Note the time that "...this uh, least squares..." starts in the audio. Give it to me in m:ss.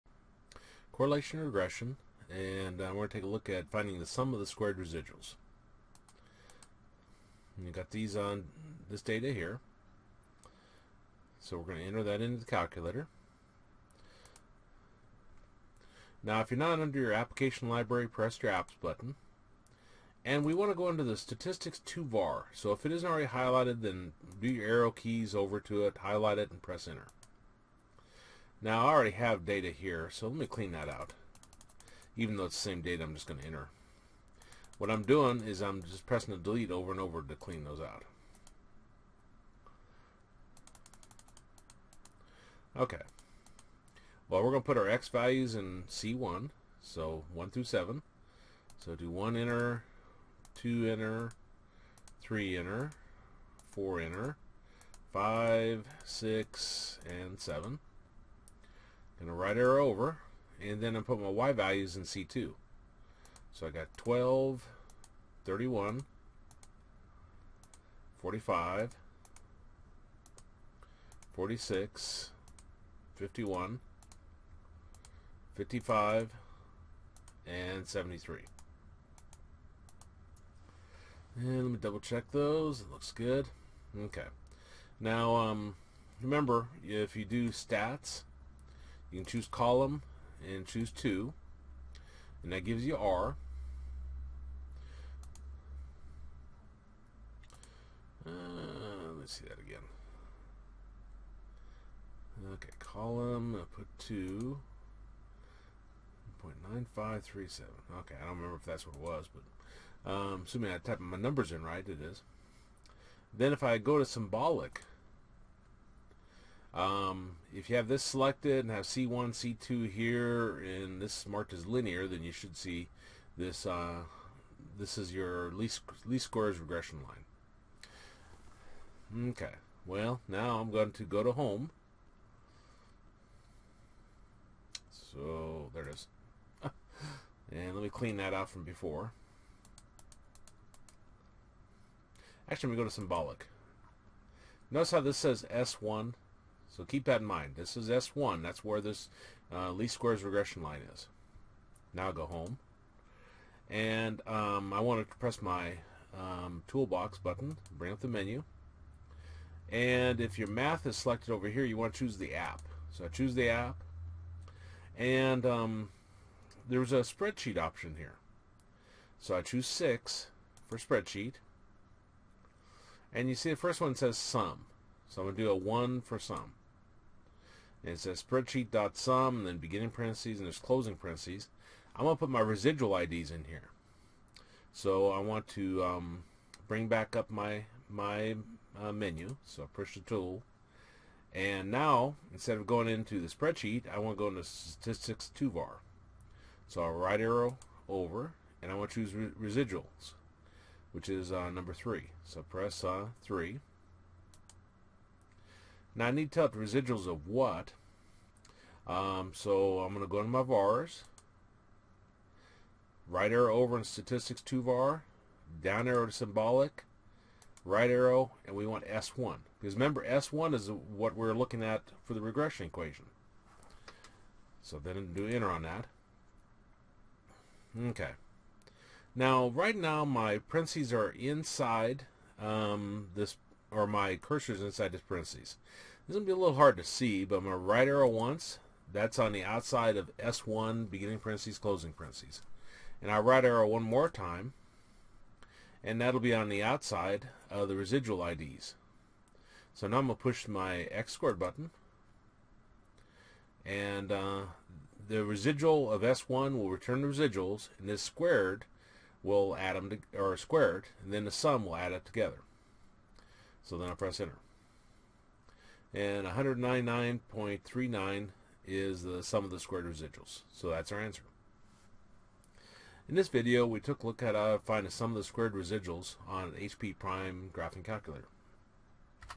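2:28.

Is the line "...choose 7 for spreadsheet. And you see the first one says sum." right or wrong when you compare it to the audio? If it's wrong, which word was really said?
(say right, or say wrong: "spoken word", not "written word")
wrong: "6", not "7".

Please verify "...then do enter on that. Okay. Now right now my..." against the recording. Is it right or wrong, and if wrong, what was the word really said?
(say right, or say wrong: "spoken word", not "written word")
right.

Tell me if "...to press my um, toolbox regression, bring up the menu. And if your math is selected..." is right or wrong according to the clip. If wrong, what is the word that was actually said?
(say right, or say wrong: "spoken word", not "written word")
wrong: "button", not "regression".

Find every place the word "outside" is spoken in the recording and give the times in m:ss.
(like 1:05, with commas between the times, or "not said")
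3:59, 4:06.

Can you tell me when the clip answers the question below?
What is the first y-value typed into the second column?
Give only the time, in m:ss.
1:03.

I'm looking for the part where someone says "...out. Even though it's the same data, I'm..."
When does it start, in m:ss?
0:30.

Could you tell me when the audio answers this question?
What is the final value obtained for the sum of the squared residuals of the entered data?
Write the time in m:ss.
4:26.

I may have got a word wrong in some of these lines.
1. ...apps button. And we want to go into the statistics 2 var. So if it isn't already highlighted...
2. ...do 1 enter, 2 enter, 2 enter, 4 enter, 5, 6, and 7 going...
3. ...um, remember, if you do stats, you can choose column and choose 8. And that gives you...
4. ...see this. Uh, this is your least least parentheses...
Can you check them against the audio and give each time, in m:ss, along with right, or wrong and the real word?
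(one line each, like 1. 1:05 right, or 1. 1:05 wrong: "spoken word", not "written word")
1. 0:18 right
2. 0:48 wrong: "3", not "2"
3. 1:25 wrong: "2", not "8"
4. 2:02 wrong: "squares", not "parentheses".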